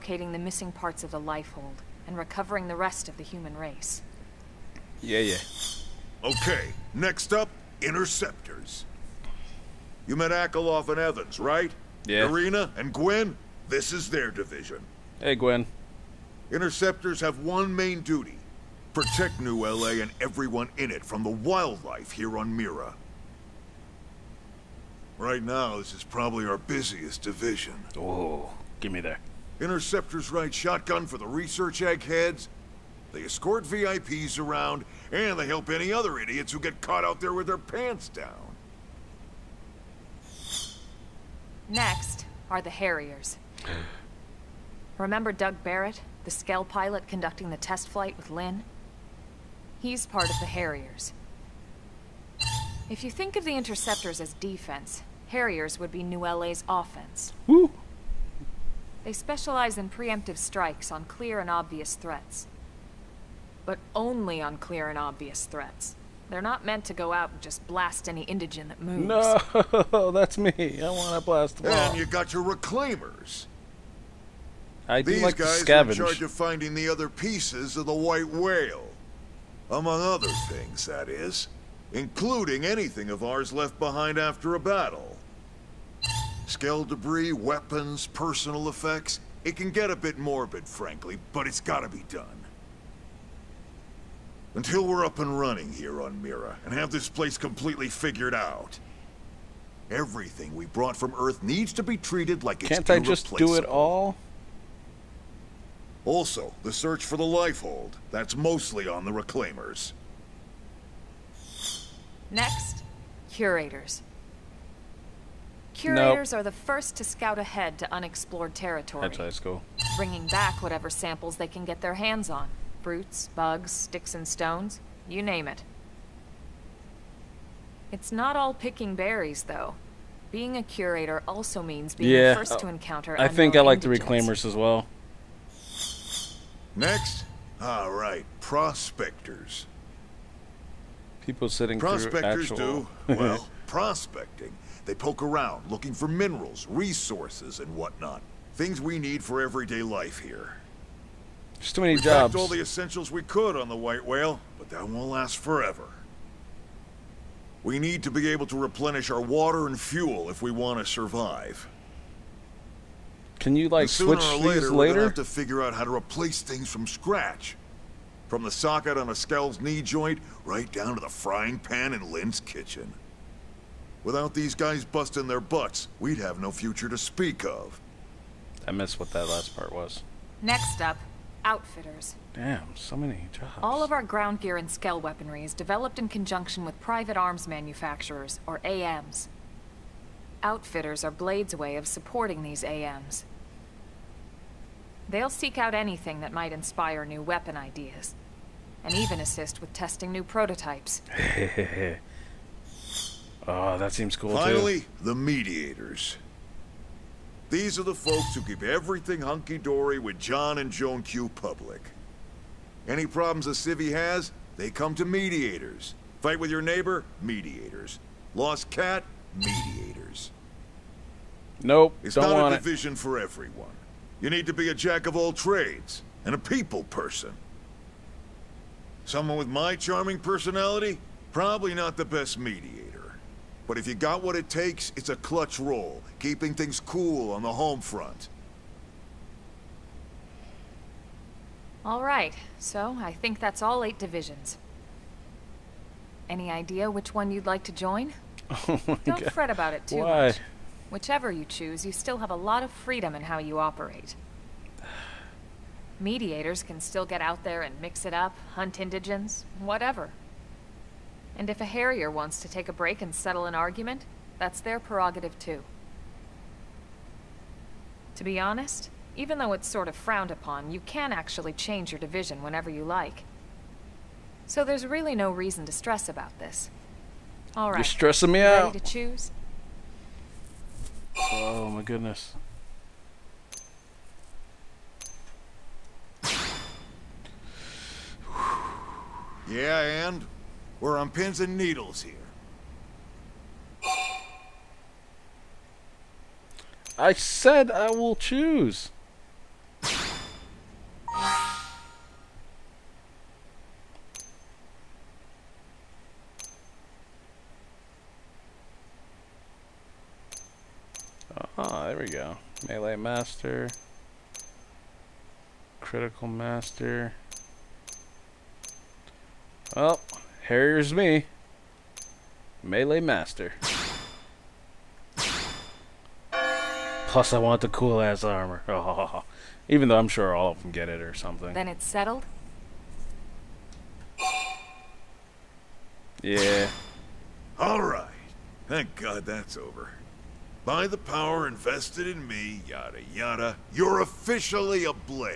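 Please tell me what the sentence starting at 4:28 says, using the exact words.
To be honest, even though it's sort of frowned upon, you can actually change your division whenever you like.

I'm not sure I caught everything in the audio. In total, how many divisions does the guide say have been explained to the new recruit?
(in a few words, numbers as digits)
8.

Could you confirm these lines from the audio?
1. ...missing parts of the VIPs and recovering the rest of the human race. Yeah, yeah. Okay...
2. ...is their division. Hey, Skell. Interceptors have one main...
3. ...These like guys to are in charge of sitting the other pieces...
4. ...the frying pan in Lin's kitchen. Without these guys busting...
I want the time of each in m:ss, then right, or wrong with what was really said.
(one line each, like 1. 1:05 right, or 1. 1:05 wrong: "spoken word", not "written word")
1. 0:00 wrong: "Lifehold", not "VIPs"
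2. 0:13 wrong: "Gwen", not "Skell"
3. 1:15 wrong: "finding", not "sitting"
4. 2:50 right.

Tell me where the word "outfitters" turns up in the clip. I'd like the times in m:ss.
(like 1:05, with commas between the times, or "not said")
3:01, 3:10.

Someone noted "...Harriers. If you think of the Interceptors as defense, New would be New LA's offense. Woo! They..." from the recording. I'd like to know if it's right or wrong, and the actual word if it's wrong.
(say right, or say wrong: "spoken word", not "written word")
wrong: "Harriers", not "New".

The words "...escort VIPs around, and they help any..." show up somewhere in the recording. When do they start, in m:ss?
0:33.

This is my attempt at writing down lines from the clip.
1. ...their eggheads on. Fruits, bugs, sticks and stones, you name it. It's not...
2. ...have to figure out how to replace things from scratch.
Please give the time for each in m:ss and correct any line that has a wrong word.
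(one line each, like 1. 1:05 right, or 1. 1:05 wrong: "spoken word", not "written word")
1. 2:01 wrong: "hands", not "eggheads"
2. 2:45 right.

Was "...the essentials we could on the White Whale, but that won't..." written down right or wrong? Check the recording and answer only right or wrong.
right.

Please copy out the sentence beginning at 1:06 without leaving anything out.
They're not meant to go out and just blast any indigen that moves.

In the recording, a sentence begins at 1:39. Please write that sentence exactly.
Everything we brought from Earth needs to be treated like Can't it's Can't I just do it all?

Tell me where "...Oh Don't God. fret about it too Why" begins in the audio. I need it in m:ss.
4:08.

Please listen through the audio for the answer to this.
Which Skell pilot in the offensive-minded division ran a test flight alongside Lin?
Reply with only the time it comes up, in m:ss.
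0:45.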